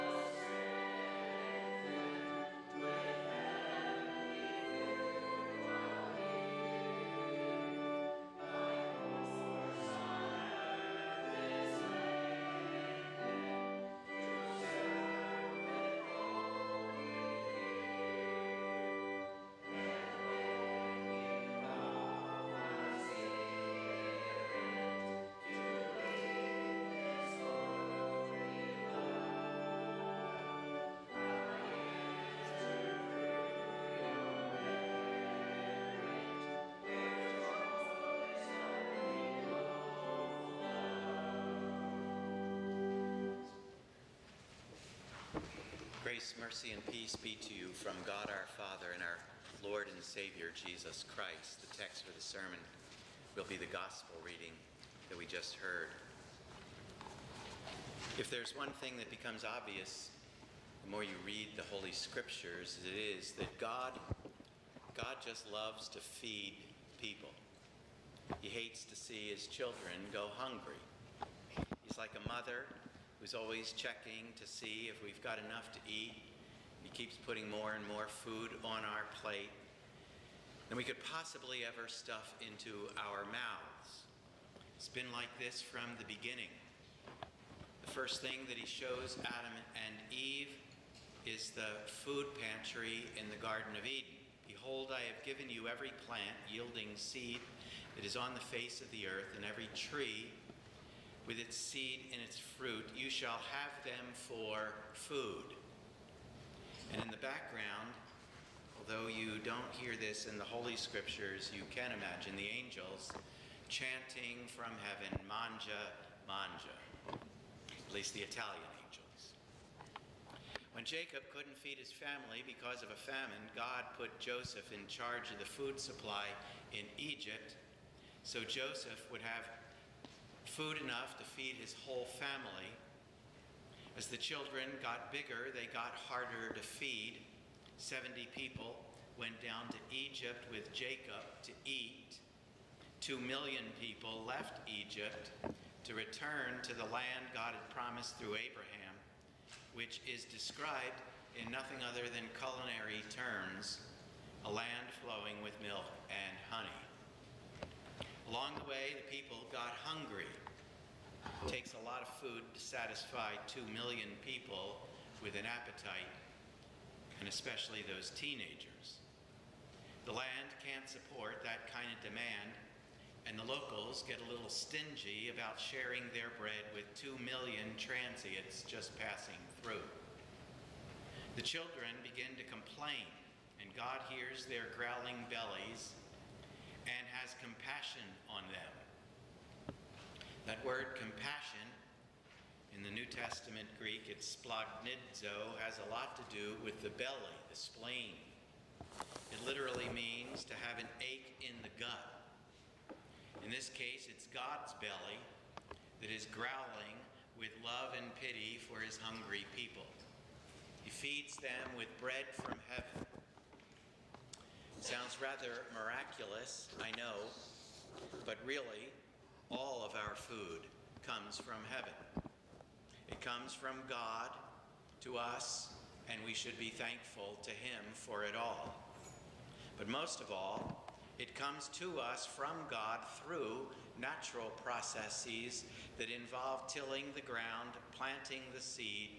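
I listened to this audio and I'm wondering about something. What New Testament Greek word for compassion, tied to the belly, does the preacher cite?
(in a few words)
splagnidzo.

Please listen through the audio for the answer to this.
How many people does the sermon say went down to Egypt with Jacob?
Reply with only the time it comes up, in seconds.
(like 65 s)
137 s.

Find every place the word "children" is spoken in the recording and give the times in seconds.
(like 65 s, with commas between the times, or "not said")
69 s, 134 s, 181 s.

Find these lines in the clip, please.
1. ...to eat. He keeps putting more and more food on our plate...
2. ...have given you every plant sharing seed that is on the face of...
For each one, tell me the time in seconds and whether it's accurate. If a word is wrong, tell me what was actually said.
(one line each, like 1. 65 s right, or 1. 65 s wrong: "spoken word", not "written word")
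1. 75 s right
2. 95 s wrong: "yielding", not "sharing".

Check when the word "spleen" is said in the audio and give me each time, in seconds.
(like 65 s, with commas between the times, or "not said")
197 s.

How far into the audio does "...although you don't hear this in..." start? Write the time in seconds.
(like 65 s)
108 s.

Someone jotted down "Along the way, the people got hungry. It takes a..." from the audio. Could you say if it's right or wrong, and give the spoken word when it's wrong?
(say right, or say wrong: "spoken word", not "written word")
right.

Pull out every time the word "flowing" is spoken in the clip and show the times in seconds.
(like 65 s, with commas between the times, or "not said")
154 s.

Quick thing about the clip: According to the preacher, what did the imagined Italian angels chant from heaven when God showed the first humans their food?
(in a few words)
Manja, Manja.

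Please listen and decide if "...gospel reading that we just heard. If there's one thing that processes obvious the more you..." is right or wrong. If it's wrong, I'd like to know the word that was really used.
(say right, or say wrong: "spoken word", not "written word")
wrong: "becomes", not "processes".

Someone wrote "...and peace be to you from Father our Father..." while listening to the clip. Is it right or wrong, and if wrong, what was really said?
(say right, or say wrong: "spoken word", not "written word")
wrong: "God", not "Father".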